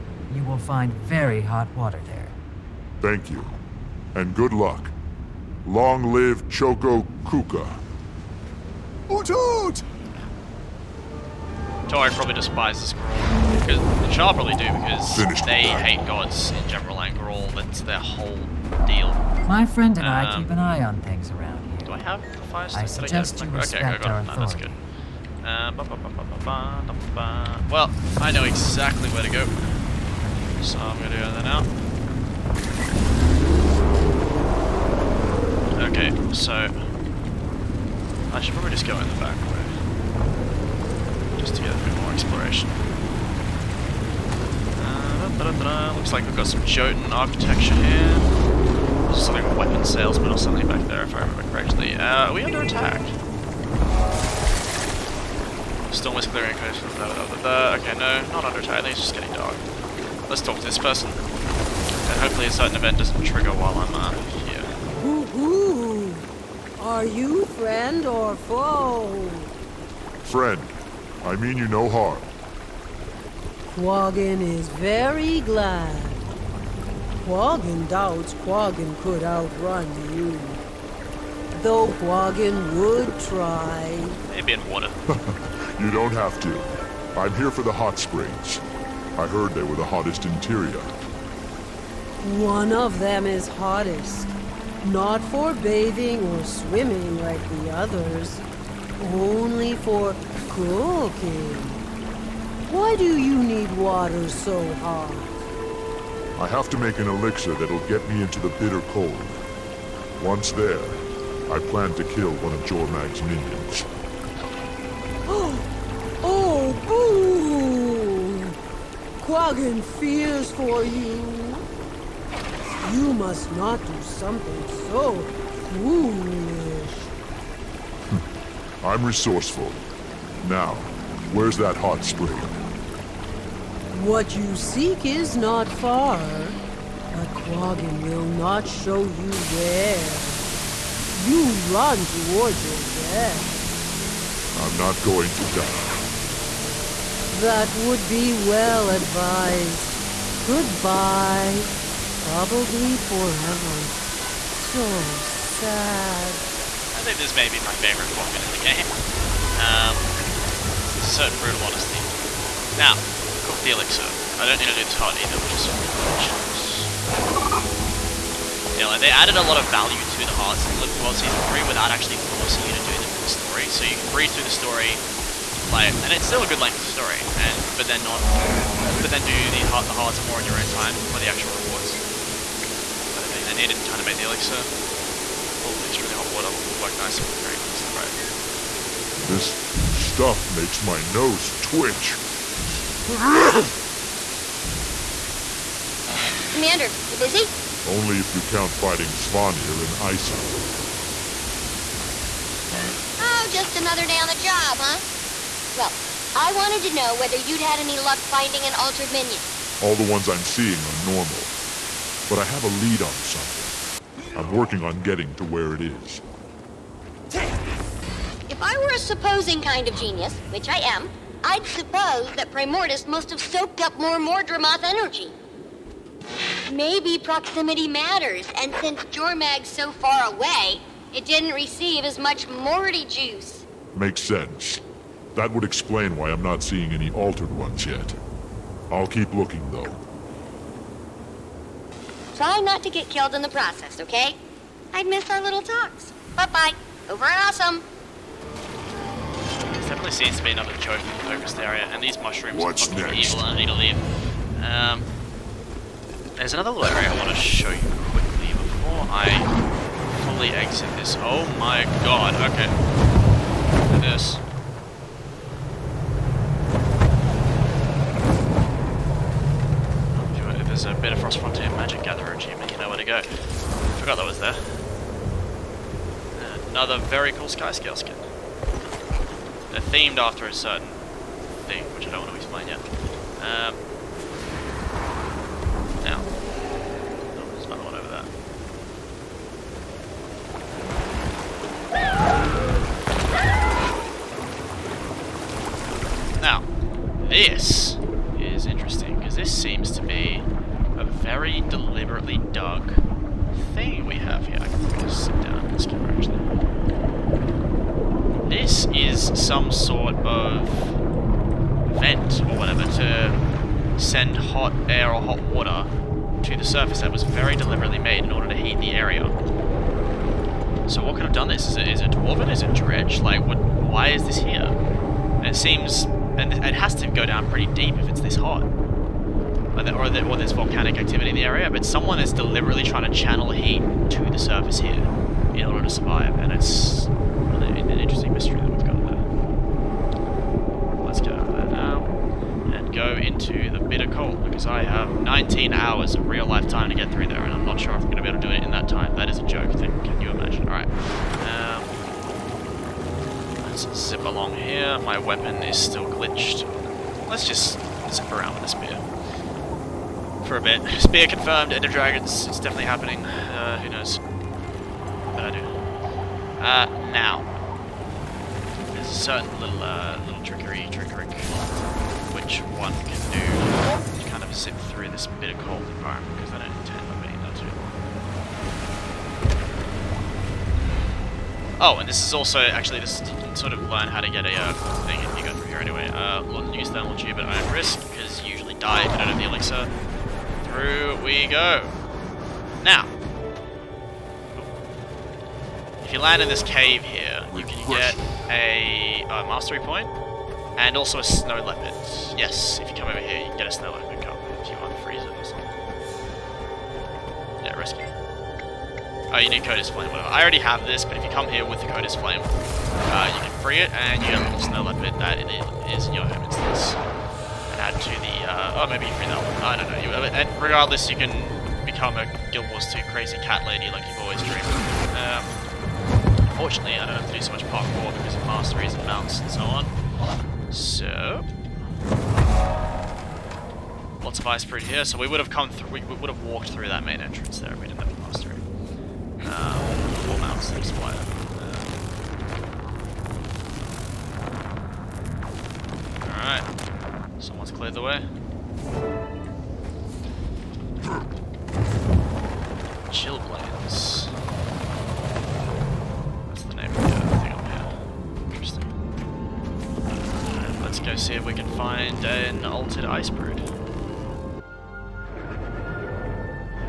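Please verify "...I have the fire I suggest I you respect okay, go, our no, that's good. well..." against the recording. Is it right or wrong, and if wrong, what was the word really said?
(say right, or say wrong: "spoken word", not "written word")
right.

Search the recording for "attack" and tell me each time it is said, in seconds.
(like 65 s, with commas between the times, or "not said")
52 s, 58 s.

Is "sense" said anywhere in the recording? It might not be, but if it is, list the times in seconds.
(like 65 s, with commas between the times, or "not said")
234 s.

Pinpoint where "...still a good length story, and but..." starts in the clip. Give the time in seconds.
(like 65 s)
176 s.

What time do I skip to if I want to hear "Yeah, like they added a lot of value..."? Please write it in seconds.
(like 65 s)
168 s.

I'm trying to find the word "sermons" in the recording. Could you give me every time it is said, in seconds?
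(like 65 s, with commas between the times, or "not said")
not said.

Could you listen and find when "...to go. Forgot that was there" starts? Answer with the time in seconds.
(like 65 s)
272 s.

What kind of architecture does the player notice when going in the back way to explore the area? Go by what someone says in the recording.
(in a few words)
Jotun.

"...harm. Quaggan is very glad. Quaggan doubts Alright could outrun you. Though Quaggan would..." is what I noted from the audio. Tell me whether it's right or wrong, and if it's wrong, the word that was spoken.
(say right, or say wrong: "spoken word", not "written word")
wrong: "Quaggan", not "Alright".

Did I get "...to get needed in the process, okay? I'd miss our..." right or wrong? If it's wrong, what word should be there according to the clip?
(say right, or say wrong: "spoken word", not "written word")
wrong: "killed", not "needed".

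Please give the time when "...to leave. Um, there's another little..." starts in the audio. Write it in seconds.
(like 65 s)
253 s.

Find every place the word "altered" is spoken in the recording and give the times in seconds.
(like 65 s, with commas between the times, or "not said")
208 s, 237 s.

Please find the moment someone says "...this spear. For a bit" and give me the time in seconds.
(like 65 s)
358 s.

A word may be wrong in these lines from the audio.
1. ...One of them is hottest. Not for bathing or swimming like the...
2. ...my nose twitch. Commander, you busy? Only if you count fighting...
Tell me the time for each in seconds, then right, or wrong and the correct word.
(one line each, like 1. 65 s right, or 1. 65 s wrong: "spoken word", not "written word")
1. 92 s right
2. 190 s right.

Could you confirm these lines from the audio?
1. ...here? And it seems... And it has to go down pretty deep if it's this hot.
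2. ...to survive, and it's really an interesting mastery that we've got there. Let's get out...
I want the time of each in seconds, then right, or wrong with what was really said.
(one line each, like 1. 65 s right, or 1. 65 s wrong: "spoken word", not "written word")
1. 324 s right
2. 335 s wrong: "mystery", not "mastery".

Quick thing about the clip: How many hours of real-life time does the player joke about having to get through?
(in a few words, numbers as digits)
19.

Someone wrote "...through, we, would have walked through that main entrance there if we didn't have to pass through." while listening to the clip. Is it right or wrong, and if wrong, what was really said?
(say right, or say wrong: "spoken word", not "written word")
right.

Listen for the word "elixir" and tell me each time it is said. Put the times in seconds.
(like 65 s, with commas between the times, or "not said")
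107 s, 163 s, 184 s, 389 s.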